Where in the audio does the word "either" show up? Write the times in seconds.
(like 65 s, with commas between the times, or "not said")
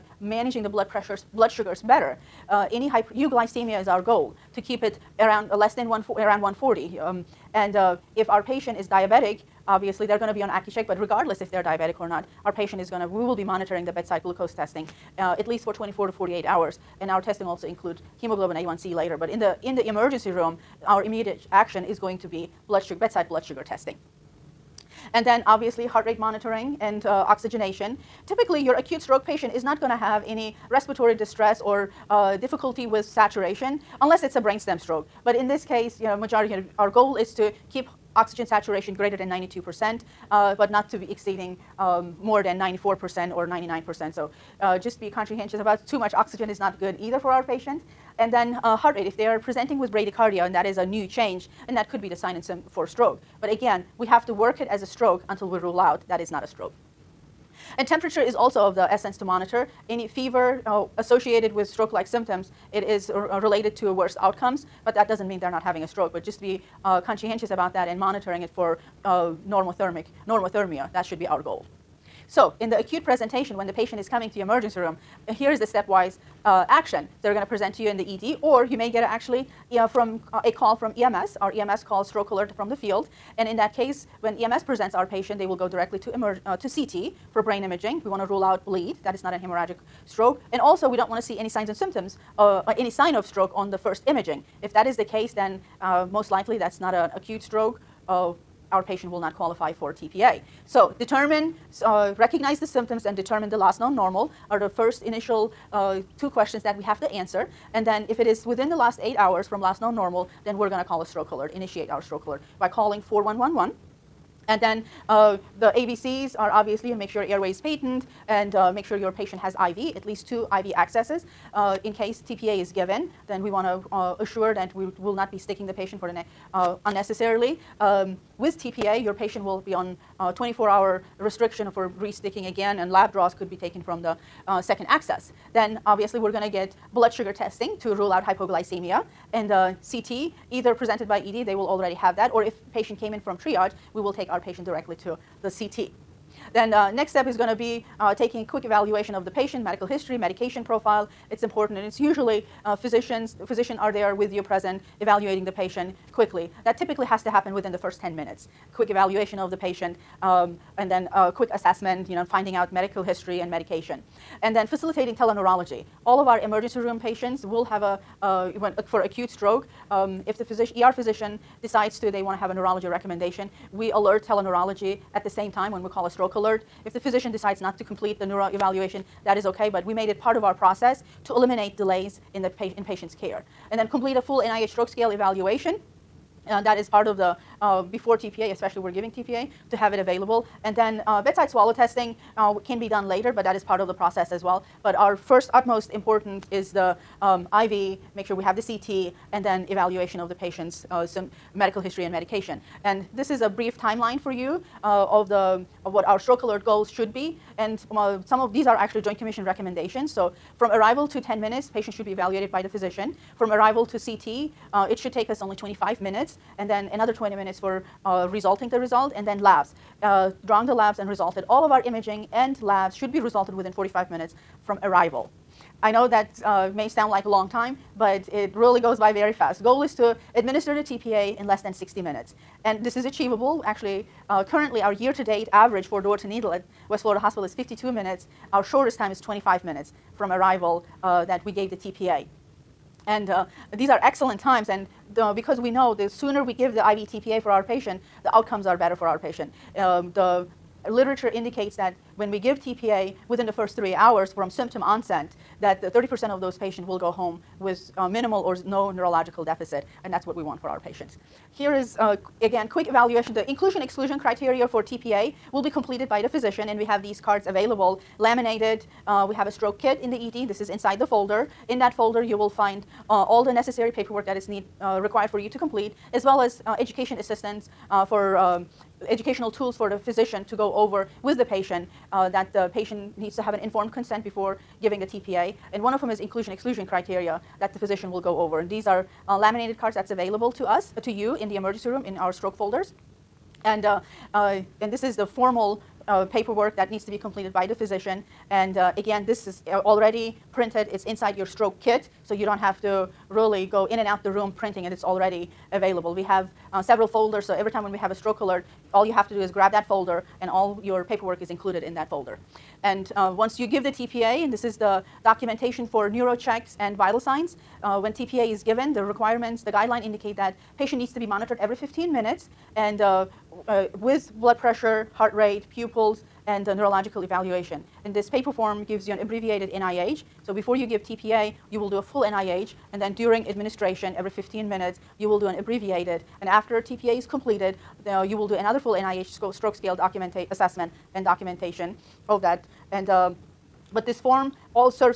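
46 s, 140 s.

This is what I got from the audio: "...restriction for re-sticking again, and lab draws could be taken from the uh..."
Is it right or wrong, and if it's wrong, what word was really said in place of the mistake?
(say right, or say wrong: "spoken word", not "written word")
right.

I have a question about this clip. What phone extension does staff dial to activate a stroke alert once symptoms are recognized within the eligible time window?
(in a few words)
4111.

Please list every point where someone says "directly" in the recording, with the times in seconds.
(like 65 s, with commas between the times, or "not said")
85 s, 144 s.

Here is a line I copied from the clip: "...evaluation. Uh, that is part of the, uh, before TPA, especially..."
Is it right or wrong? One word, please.
right.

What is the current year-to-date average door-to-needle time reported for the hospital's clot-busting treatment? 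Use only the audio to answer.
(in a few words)
52 minutes.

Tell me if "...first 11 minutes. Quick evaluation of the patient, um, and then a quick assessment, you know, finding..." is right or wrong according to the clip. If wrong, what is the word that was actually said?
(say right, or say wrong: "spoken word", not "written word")
wrong: "10", not "11".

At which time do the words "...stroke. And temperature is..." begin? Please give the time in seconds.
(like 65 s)
56 s.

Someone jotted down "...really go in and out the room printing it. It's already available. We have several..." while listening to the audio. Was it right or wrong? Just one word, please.
right.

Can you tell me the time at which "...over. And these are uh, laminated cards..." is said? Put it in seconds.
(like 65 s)
288 s.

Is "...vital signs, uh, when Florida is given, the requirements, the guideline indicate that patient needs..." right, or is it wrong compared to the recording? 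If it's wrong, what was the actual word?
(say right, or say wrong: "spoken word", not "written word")
wrong: "TPA", not "Florida".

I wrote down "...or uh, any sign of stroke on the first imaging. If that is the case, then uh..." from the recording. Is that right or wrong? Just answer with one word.
right.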